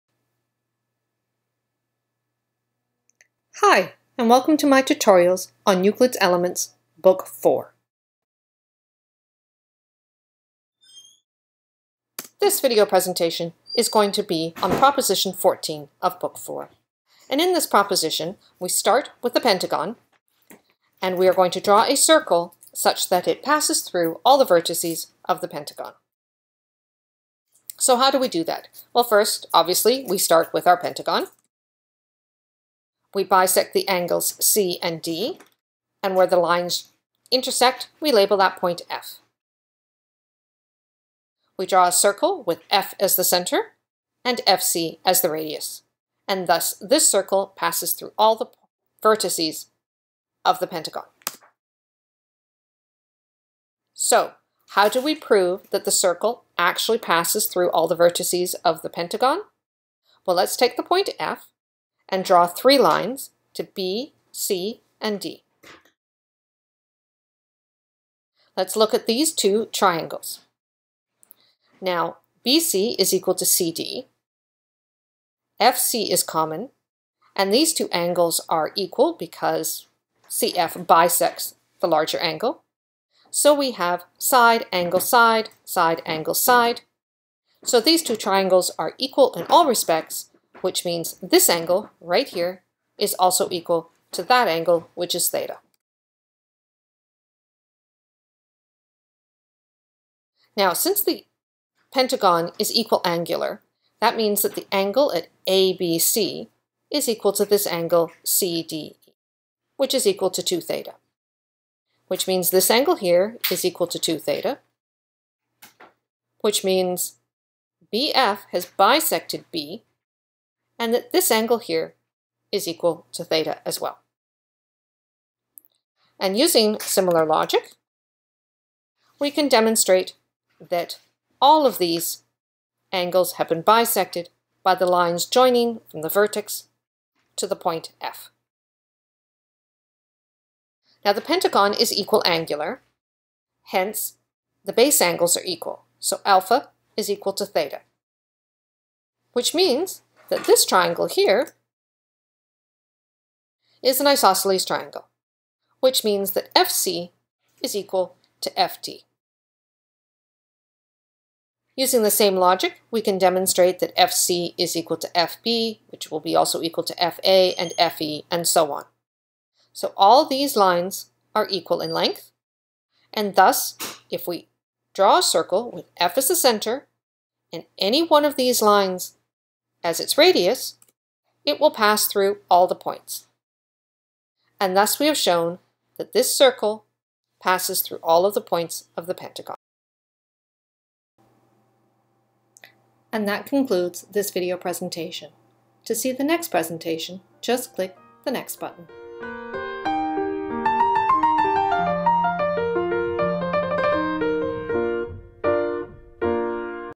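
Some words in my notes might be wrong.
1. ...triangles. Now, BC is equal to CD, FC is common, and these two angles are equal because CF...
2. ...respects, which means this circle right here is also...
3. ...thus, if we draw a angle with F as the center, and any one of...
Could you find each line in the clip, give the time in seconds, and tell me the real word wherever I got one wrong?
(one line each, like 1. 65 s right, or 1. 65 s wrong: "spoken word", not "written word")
1. 69 s right
2. 89 s wrong: "angle", not "circle"
3. 173 s wrong: "circle", not "angle".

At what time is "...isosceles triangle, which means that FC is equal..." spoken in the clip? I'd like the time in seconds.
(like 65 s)
154 s.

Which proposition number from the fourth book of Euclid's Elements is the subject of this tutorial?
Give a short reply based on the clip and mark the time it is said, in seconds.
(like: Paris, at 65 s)
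14, at 14 s.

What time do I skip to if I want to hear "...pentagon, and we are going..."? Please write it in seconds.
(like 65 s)
19 s.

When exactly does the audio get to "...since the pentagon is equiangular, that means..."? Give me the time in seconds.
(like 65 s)
100 s.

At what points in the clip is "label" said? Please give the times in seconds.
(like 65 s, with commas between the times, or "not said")
38 s.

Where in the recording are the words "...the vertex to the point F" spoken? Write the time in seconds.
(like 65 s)
136 s.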